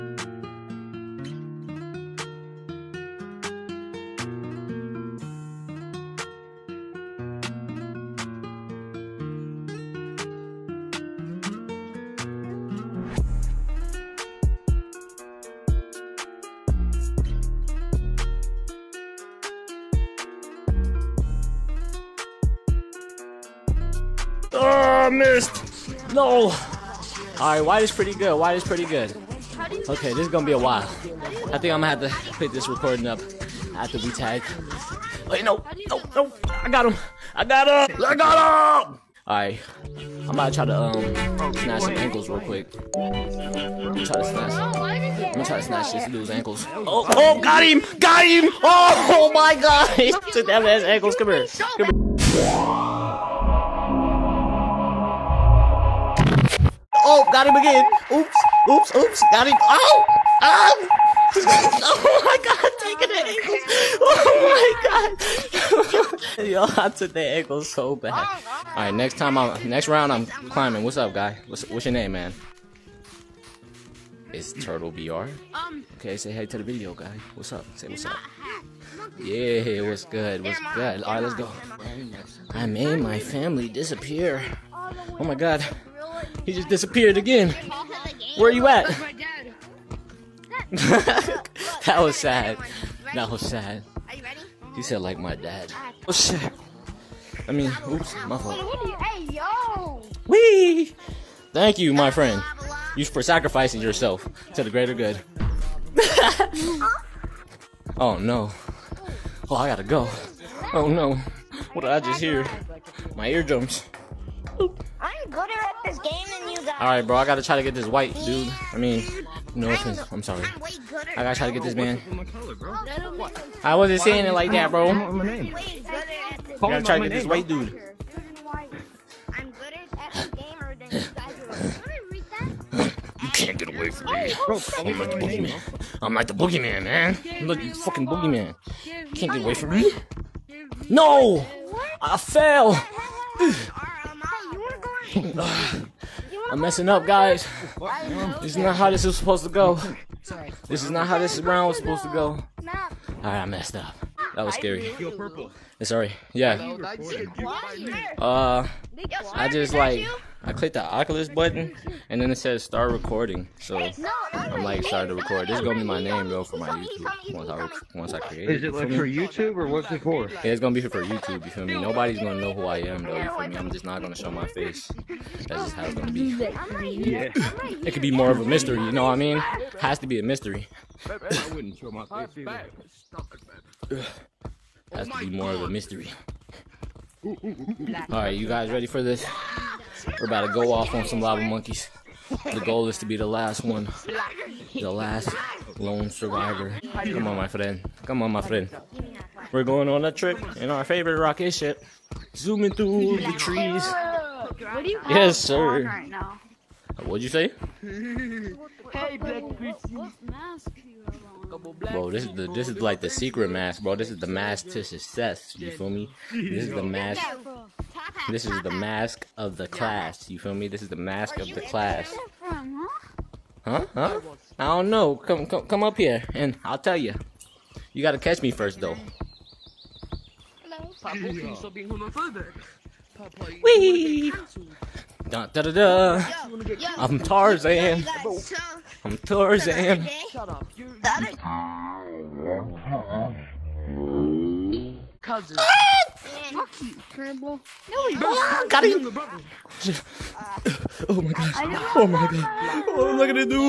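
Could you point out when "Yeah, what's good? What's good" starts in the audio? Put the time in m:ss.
1:19.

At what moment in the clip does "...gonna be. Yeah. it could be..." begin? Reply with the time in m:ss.
2:55.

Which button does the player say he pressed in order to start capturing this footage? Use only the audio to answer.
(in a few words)
Oculus button.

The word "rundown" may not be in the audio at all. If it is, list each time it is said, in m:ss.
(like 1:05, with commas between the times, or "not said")
not said.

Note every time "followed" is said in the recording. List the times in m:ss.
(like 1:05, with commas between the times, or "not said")
not said.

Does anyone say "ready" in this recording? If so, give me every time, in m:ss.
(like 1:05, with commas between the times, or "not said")
3:08.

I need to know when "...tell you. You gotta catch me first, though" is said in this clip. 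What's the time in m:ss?
3:46.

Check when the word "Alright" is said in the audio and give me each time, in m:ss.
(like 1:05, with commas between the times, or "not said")
2:32, 3:08.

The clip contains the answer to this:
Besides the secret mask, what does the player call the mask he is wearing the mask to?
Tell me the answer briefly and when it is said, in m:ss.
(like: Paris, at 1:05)
success, at 3:34.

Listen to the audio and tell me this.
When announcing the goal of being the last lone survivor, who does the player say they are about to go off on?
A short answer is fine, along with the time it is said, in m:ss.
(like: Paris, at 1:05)
lava monkeys, at 3:11.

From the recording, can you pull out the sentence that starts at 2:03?
I wasn't saying it like that, bro.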